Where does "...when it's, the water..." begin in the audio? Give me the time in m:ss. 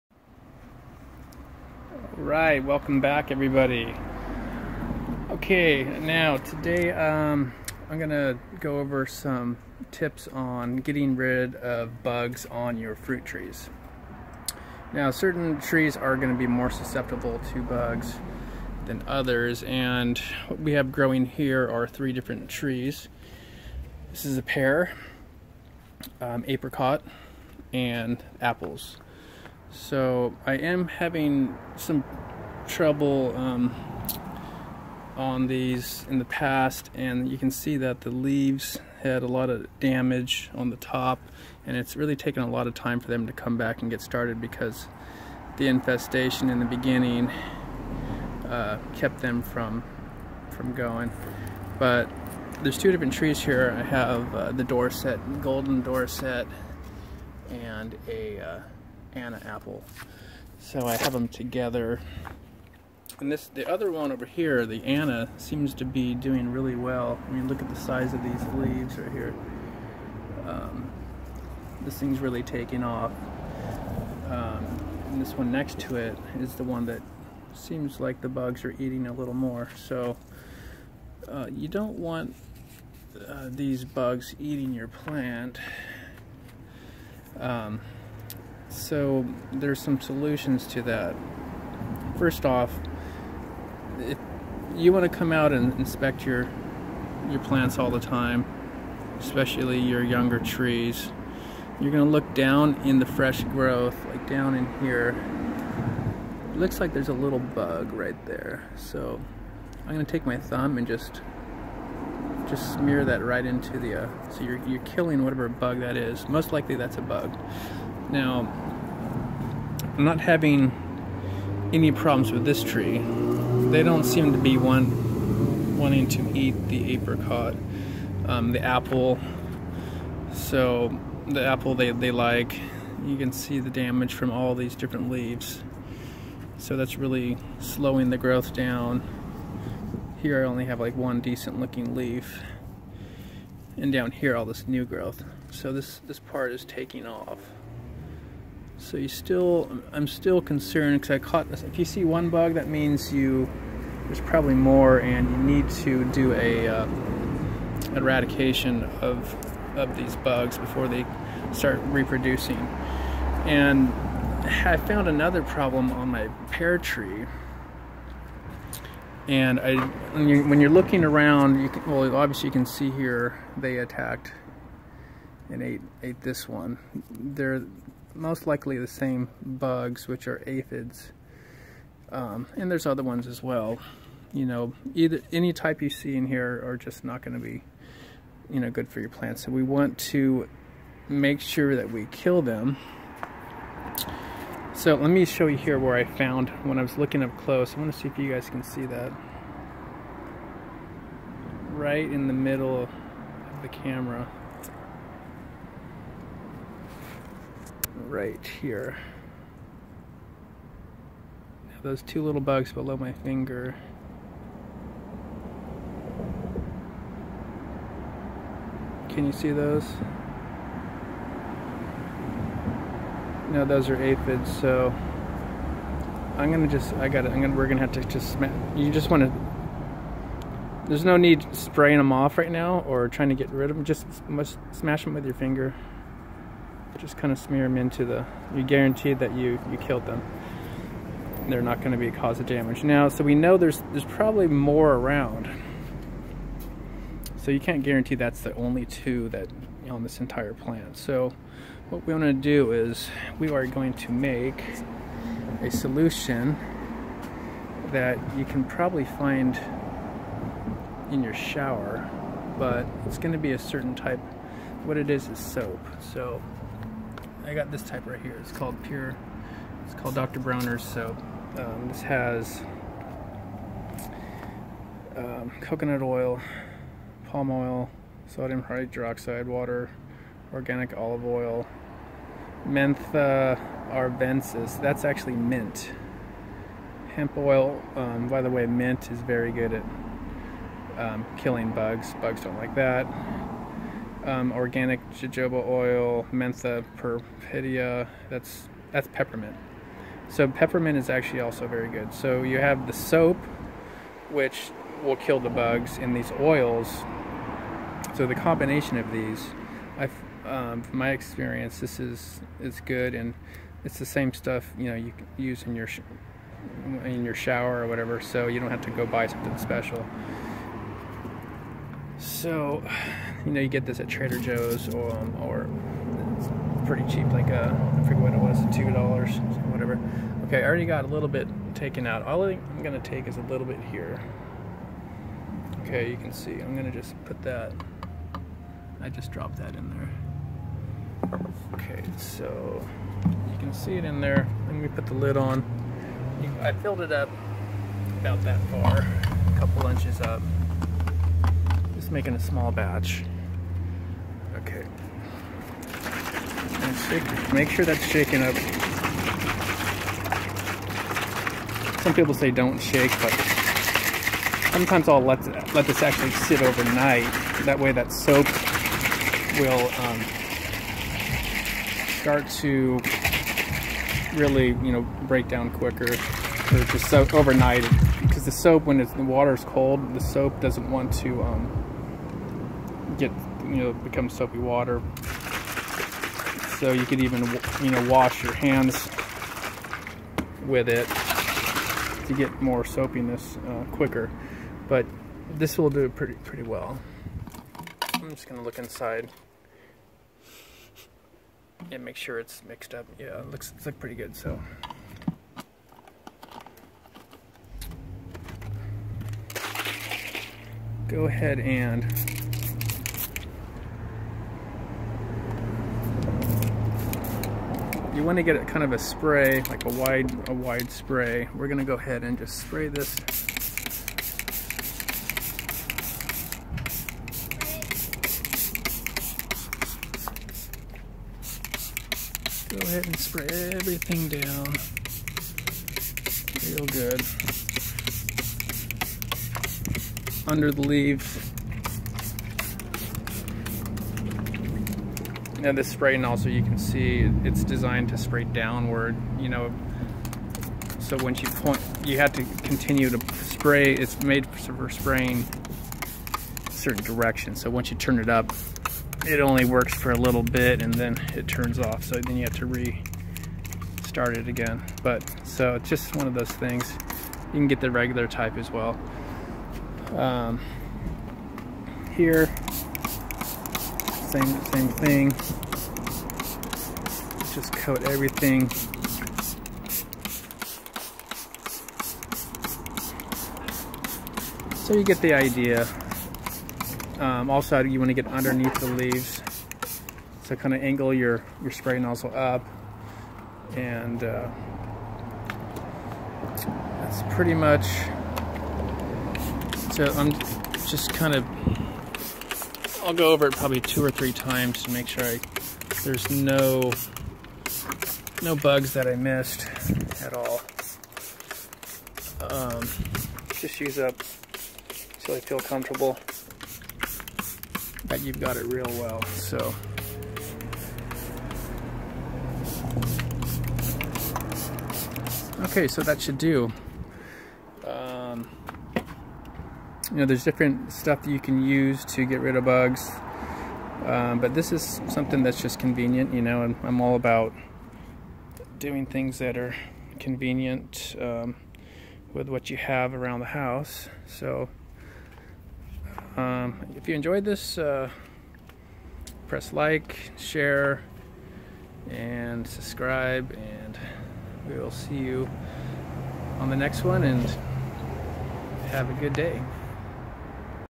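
6:18.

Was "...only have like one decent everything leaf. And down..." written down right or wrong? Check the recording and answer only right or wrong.
wrong.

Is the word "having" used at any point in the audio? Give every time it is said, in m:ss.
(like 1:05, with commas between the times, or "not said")
0:30, 2:00.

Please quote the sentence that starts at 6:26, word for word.
So you could even, you know, wash your hands with it to get more soapiness uh, quicker.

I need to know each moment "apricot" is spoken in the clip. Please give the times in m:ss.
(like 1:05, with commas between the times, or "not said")
0:26, 2:06.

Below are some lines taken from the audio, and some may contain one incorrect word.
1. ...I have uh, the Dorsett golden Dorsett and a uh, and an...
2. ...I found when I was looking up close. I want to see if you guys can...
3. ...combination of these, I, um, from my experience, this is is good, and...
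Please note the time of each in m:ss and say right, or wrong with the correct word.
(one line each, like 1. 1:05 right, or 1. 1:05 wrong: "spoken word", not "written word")
1. 0:53 right
2. 3:15 right
3. 5:08 right.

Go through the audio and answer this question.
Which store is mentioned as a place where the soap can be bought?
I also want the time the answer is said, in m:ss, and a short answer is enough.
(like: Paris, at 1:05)
Trader Joe's, at 5:24.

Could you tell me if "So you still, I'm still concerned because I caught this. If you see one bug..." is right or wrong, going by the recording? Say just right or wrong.
right.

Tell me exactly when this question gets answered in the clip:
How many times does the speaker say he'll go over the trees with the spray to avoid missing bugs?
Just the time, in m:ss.
8:23.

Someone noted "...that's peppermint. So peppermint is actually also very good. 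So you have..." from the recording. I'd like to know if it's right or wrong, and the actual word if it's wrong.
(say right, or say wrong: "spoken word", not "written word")
right.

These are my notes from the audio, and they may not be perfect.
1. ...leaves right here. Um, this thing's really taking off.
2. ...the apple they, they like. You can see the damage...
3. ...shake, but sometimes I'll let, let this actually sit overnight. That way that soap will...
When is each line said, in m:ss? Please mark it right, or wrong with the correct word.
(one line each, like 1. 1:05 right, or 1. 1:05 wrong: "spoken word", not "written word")
1. 1:08 right
2. 2:11 right
3. 6:02 right.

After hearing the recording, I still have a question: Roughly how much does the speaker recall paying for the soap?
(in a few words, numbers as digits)
2 dollars.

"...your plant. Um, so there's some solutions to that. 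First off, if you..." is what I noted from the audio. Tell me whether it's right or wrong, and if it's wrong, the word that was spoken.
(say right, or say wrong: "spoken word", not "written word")
right.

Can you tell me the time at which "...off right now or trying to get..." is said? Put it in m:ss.
3:52.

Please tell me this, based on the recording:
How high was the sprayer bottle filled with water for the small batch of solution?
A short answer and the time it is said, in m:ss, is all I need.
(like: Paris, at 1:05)
a couple inches, at 5:48.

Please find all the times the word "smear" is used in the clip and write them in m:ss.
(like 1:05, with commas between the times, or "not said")
1:52, 3:57.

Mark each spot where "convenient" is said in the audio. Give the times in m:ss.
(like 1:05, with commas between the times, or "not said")
8:55, 9:00.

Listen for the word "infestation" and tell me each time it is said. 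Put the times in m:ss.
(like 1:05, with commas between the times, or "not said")
0:45.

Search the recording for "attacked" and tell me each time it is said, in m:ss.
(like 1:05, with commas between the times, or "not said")
2:53.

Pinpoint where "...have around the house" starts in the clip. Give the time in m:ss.
9:02.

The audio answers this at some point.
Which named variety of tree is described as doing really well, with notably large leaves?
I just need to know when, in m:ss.
1:04.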